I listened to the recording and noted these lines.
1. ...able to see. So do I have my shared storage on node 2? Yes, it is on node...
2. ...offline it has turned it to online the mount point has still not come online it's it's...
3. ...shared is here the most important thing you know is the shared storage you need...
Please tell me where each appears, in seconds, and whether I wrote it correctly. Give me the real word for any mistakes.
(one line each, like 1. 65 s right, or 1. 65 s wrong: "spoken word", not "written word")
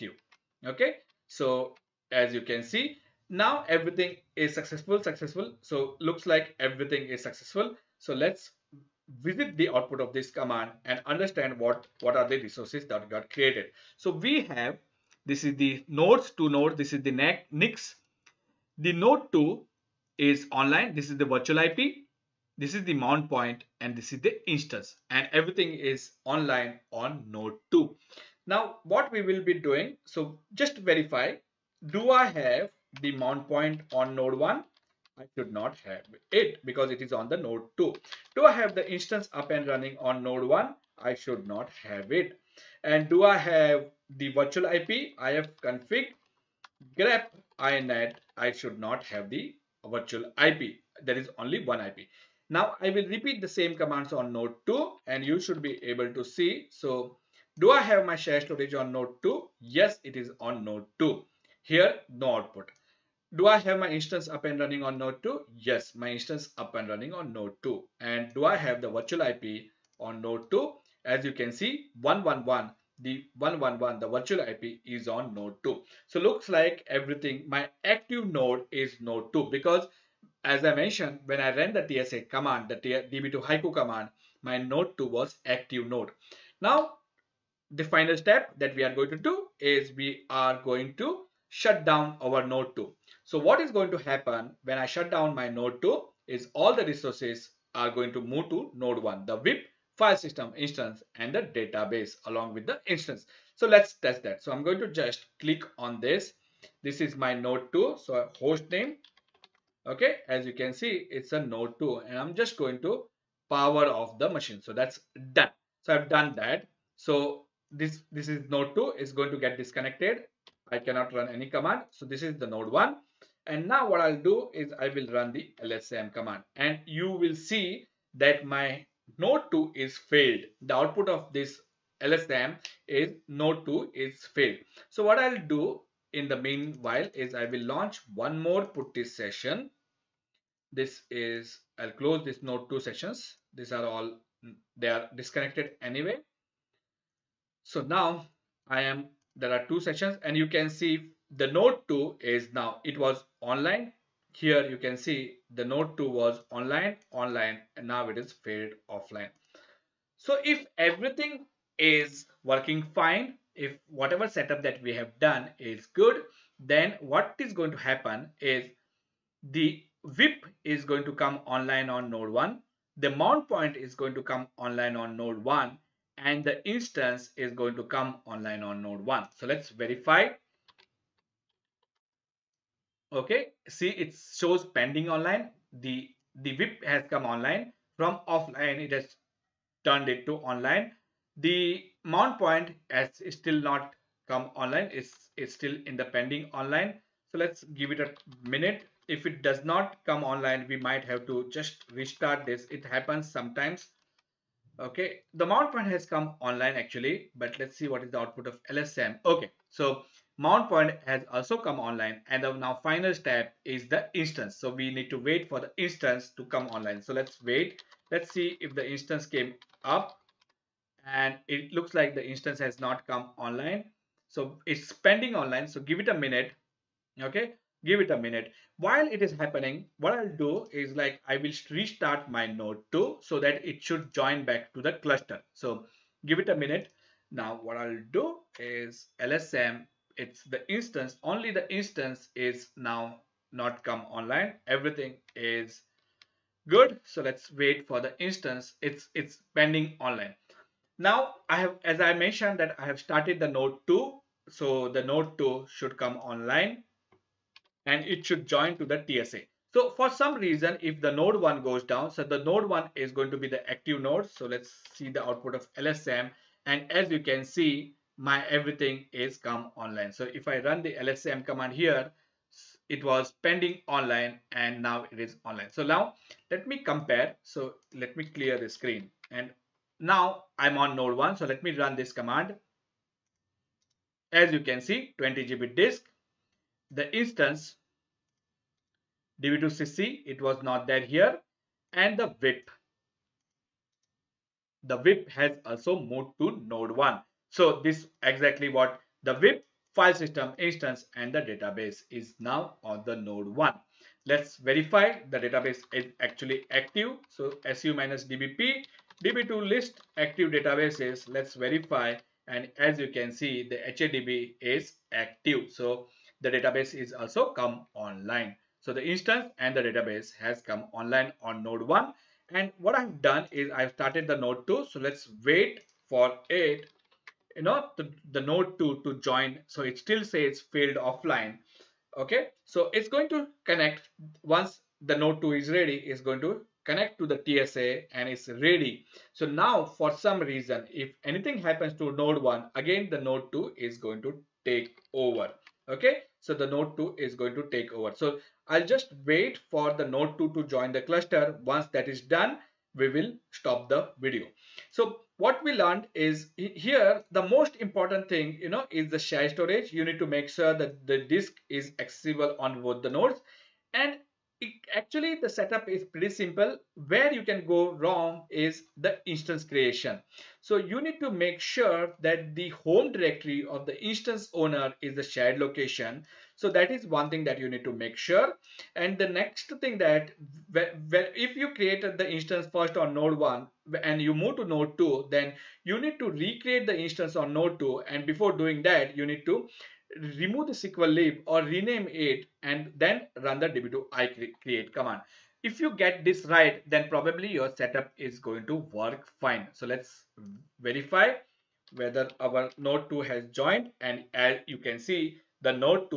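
1. 55 s right
2. 188 s right
3. 355 s wrong: "learned", not "shared".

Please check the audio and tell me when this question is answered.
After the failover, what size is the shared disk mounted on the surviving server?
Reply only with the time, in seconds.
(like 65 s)
285 s.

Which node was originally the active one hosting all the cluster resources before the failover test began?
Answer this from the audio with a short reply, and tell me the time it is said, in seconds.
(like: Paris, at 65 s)
node 2, at 77 s.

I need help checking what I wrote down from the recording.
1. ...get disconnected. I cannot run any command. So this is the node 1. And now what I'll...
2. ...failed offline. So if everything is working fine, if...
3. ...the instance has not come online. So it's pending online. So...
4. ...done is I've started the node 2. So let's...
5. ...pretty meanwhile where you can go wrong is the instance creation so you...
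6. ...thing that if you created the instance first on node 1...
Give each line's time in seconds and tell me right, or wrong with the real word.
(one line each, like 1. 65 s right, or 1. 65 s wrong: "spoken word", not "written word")
1. 119 s right
2. 158 s right
3. 222 s right
4. 323 s right
5. 366 s wrong: "simple", not "meanwhile"
6. 379 s right.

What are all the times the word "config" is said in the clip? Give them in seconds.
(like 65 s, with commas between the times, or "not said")
45 s.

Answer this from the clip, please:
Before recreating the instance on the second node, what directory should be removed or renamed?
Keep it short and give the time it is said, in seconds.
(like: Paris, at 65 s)
SQL lib, at 390 s.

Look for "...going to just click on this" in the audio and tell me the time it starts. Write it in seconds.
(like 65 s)
104 s.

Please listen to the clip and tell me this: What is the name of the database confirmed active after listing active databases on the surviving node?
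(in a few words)
HADB.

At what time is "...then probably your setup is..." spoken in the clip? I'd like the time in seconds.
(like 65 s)
396 s.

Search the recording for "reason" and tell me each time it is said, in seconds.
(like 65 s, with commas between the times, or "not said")
260 s, 340 s.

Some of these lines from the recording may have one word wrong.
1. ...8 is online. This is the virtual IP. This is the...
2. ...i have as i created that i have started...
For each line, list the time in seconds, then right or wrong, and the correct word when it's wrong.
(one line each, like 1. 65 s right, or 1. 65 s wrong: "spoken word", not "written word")
1. 19 s wrong: "2", not "8"
2. 251 s wrong: "mentioned", not "created".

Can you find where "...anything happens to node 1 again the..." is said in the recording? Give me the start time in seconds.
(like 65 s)
341 s.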